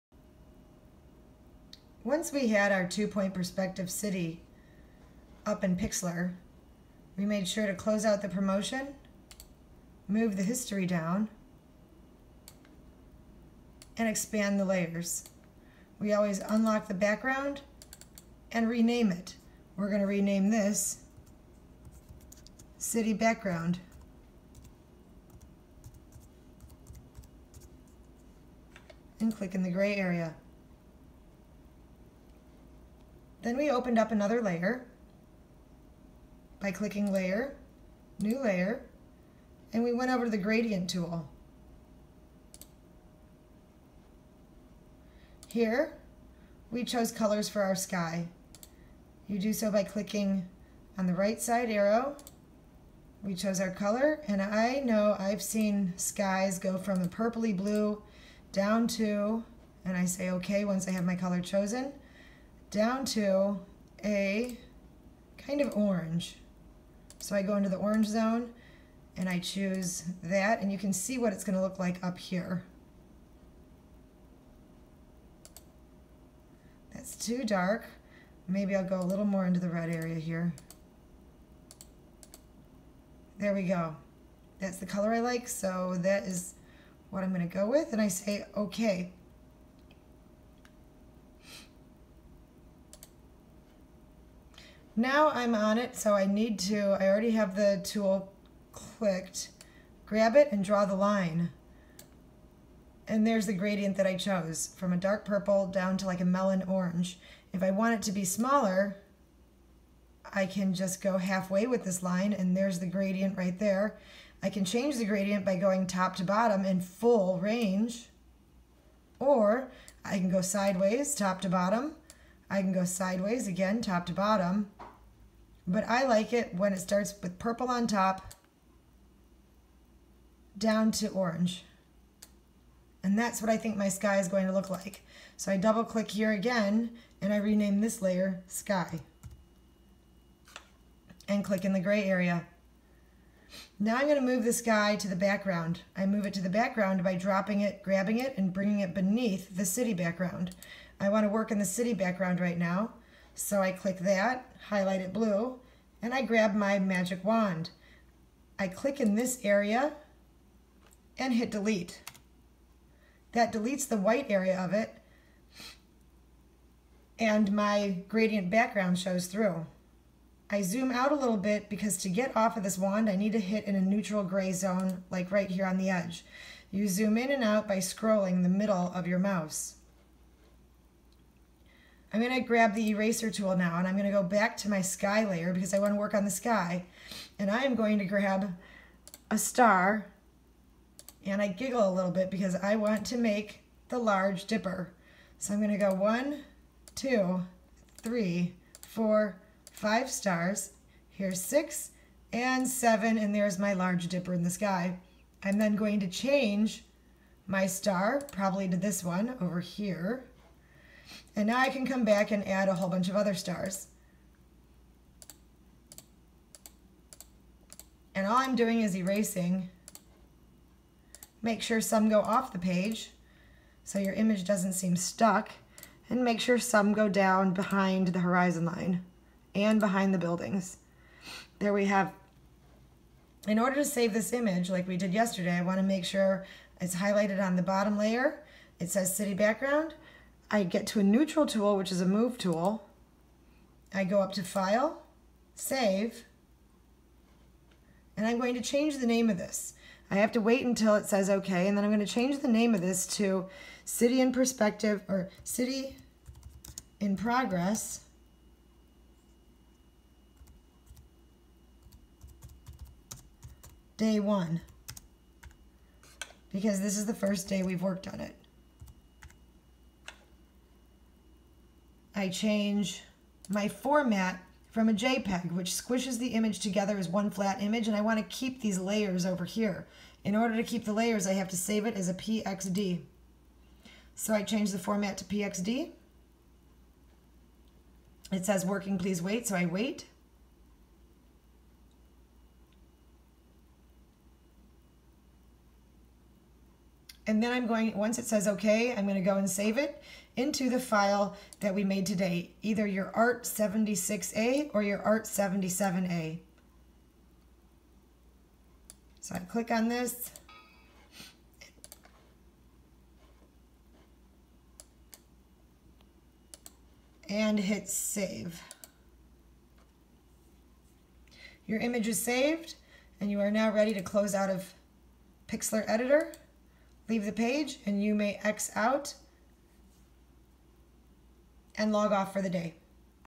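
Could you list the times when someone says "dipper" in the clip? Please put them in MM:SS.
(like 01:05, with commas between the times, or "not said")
03:14, 03:24.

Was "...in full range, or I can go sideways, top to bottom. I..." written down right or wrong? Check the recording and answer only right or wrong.
right.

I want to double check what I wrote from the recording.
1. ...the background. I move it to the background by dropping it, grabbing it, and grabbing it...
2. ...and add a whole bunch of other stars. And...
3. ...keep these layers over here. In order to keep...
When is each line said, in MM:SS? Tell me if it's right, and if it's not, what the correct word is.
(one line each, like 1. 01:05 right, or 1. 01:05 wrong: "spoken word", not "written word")
1. 02:25 wrong: "bringing", not "grabbing"
2. 03:32 right
3. 04:38 right.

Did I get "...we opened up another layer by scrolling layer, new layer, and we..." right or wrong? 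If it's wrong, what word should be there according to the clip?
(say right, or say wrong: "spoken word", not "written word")
wrong: "clicking", not "scrolling".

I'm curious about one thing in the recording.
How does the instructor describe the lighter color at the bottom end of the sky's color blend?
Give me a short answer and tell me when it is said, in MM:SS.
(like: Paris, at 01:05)
melon orange, at 01:46.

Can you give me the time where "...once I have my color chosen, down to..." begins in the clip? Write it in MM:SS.
01:00.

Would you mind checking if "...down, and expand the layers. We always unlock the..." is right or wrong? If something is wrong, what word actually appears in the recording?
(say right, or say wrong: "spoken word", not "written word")
right.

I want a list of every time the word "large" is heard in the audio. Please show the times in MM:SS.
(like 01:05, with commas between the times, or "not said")
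03:13, 03:23.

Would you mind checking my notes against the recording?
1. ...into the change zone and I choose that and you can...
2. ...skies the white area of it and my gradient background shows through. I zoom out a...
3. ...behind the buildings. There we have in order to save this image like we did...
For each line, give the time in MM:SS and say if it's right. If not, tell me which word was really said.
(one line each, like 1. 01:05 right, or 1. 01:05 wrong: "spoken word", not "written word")
1. 01:07 wrong: "orange", not "change"
2. 02:43 wrong: "deletes", not "skies"
3. 03:49 right.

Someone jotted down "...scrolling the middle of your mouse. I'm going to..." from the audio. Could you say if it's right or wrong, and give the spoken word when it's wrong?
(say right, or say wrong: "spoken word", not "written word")
right.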